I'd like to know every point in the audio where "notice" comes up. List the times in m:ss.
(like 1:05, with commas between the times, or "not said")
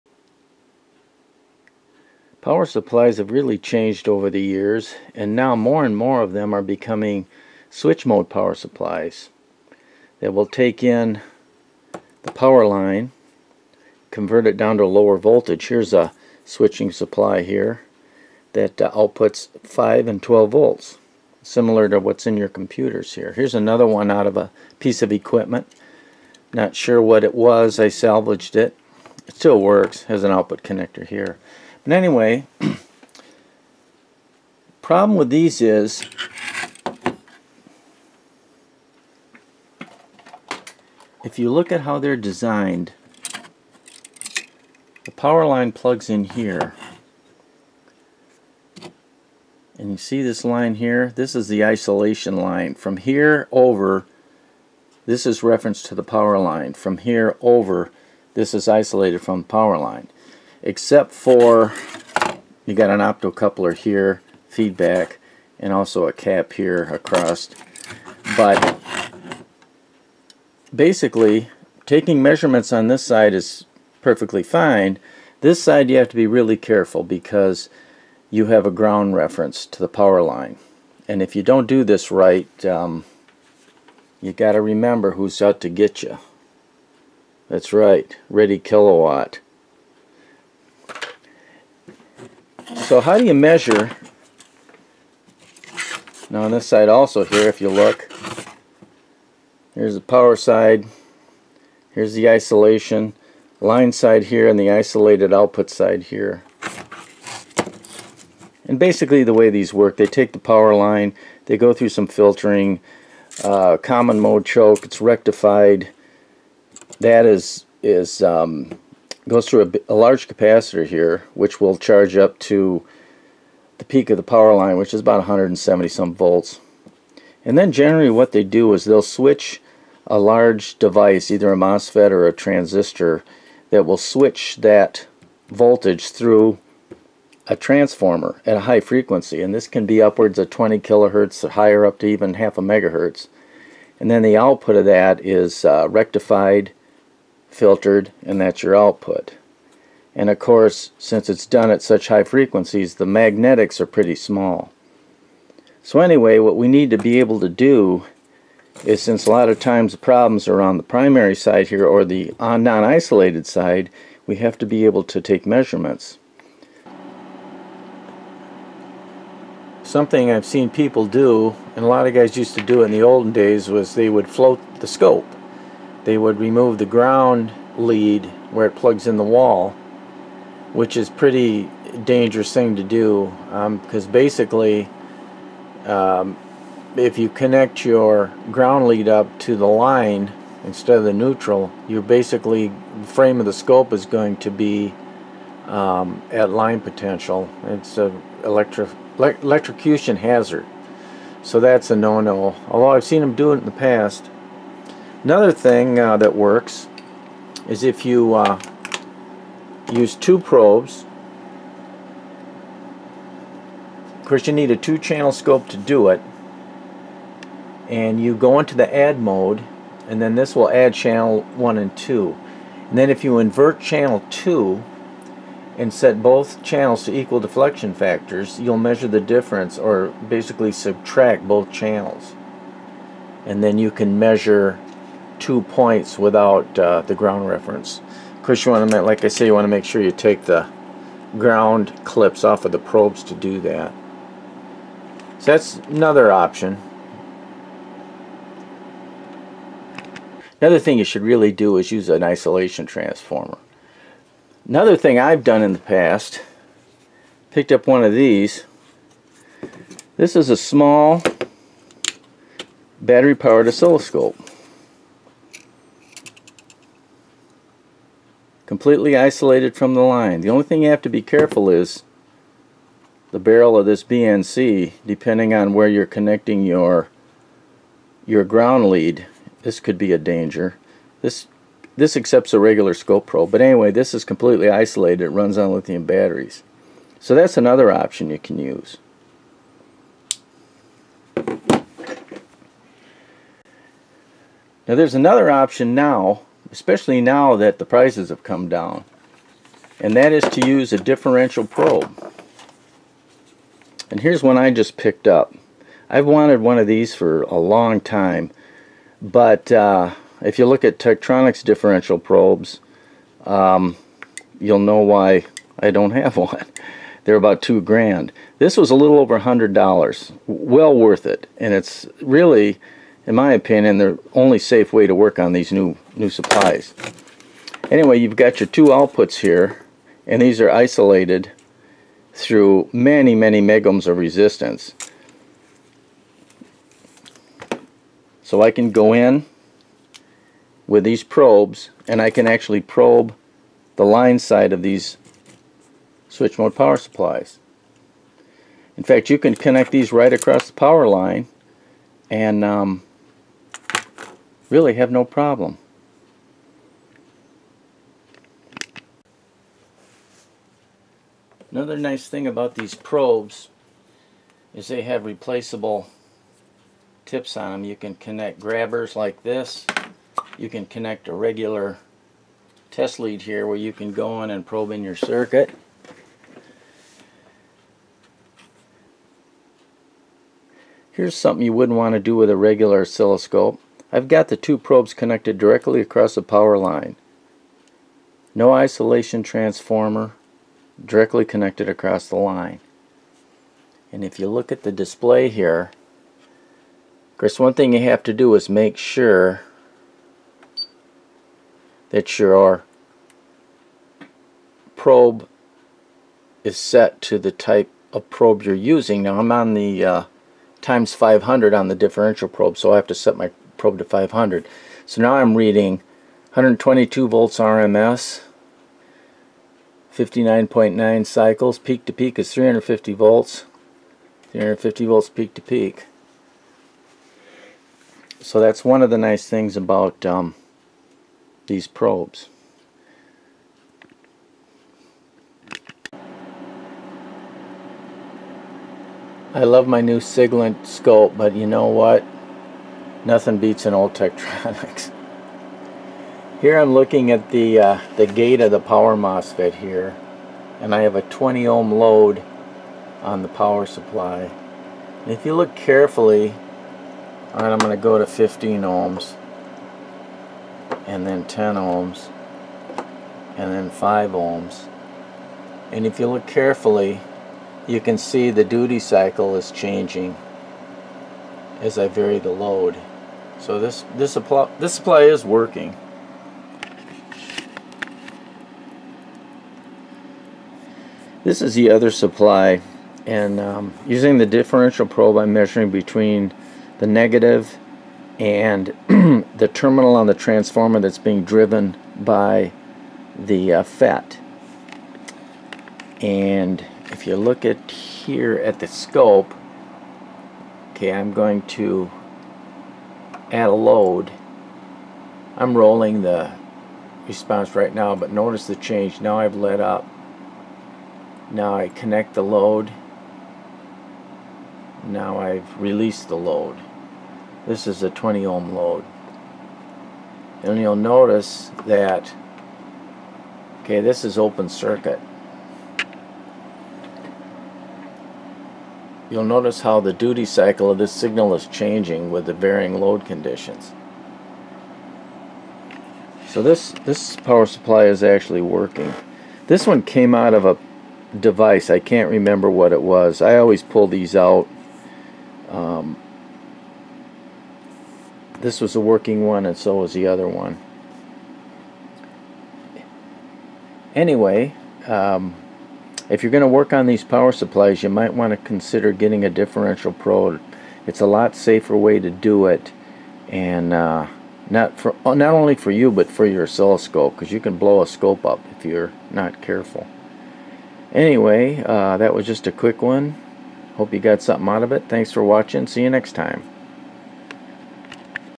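8:28, 8:40, 8:49.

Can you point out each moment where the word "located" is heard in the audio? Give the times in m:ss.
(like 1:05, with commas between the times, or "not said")
not said.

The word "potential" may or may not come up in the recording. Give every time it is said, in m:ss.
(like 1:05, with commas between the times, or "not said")
3:16.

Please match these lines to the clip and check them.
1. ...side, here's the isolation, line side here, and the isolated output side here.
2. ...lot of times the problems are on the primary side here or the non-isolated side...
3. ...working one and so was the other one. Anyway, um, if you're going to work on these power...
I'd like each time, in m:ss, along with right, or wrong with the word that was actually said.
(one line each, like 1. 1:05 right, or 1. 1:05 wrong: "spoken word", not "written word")
1. 1:40 right
2. 2:39 right
3. 9:08 right.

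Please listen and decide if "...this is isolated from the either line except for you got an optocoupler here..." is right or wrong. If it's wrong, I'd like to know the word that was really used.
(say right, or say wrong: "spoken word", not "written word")
wrong: "power", not "either".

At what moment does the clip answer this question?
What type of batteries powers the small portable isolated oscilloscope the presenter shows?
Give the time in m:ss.
4:45.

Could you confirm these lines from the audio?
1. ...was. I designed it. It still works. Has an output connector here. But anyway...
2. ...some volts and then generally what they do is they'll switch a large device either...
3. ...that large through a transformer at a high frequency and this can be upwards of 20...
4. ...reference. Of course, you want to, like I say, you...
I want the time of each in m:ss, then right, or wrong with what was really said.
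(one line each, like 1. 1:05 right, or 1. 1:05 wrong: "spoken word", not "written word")
1. 0:27 wrong: "salvaged", not "designed"
2. 2:05 right
3. 2:14 wrong: "voltage", not "large"
4. 3:57 right.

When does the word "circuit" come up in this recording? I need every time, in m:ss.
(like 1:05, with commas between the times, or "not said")
6:15, 8:44.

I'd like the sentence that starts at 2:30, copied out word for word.
And of course, since it's done at such high frequencies, the magnetics are pretty small.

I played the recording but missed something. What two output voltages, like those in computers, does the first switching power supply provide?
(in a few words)
5 and 12 volts.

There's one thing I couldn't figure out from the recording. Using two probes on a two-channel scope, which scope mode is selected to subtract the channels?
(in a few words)
add mode.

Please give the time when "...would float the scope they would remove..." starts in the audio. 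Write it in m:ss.
2:54.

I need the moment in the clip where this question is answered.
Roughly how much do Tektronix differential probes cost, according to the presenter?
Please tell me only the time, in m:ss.
5:17.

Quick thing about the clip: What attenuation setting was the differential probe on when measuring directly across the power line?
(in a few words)
times 500.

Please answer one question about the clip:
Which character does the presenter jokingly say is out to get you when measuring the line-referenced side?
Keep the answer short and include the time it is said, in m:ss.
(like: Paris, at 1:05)
Reddy Kilowatt, at 1:28.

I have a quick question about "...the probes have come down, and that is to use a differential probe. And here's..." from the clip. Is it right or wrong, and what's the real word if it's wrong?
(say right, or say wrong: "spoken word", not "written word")
wrong: "prices", not "probes".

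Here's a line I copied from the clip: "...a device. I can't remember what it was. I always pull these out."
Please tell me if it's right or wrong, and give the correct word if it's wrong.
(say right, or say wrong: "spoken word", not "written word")
right.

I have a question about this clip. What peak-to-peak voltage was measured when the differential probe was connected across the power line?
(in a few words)
350 volts.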